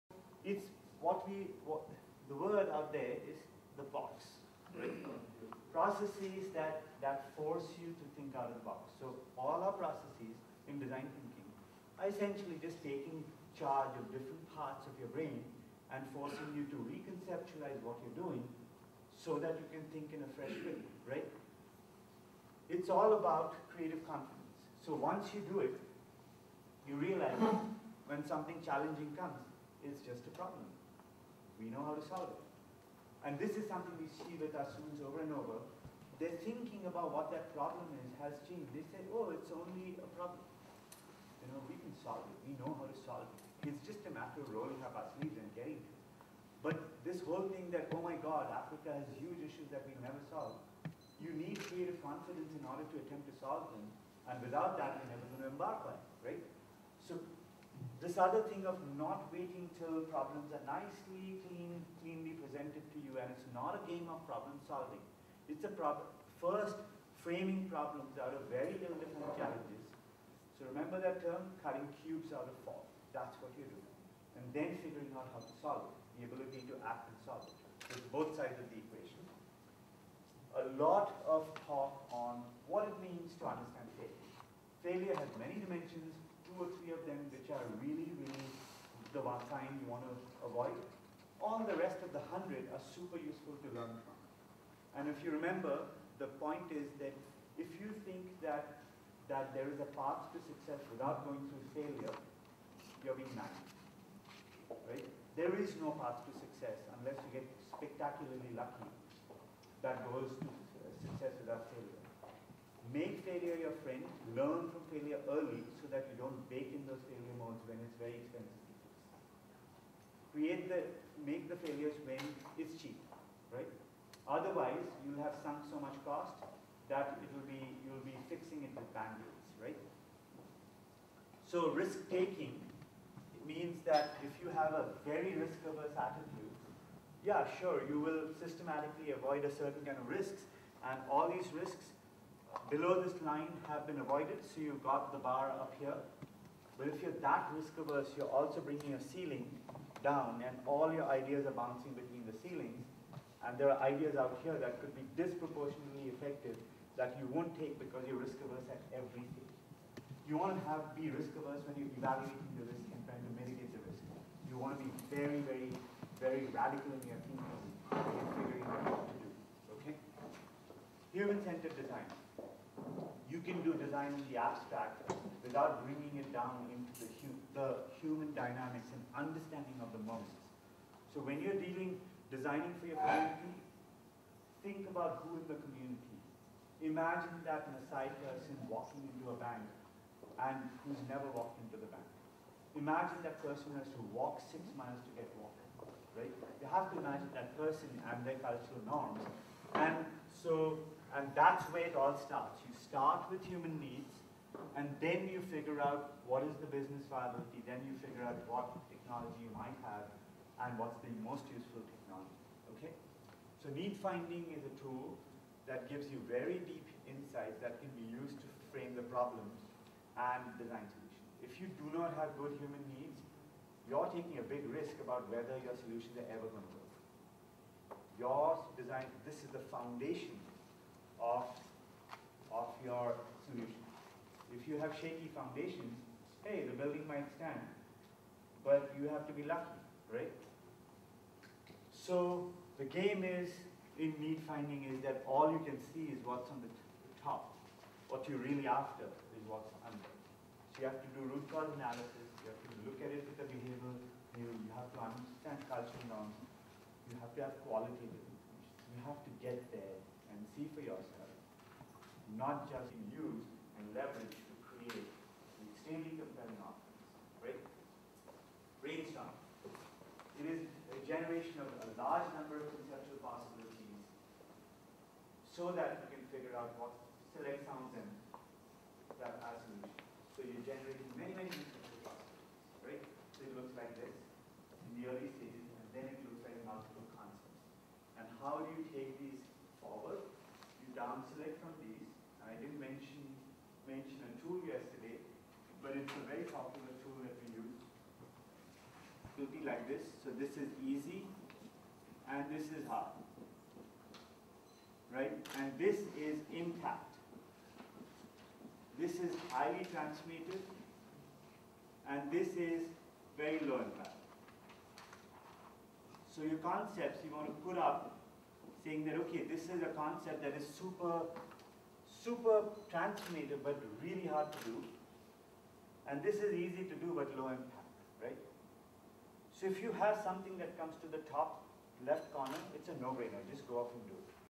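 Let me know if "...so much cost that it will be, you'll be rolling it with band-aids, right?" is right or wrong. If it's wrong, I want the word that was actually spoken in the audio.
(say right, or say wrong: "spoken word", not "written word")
wrong: "fixing", not "rolling".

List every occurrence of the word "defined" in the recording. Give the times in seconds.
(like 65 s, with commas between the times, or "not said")
68 s.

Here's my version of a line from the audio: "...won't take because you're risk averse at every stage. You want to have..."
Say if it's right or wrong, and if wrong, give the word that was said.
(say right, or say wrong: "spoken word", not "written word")
right.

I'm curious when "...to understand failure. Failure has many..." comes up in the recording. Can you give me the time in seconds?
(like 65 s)
83 s.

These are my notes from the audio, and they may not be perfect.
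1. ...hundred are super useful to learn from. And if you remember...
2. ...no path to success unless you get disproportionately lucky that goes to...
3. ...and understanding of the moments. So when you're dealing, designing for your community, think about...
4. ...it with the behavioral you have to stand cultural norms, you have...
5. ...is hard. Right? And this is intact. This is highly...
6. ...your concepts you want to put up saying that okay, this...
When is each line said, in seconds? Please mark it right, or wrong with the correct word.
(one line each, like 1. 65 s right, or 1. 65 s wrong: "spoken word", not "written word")
1. 92 s right
2. 105 s wrong: "spectacularly", not "disproportionately"
3. 178 s right
4. 253 s wrong: "understand", not "stand"
5. 302 s right
6. 316 s right.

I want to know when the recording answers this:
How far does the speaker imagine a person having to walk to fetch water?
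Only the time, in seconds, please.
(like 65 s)
194 s.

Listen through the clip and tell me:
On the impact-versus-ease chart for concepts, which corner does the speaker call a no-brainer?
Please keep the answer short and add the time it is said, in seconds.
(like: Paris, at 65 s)
Top left corner, at 331 s.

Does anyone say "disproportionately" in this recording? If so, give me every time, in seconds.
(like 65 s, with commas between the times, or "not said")
155 s.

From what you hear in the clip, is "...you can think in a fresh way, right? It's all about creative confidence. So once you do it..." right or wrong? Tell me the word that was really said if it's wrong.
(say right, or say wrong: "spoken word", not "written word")
right.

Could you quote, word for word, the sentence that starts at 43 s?
It's just a matter of rolling up our sleeves and getting it.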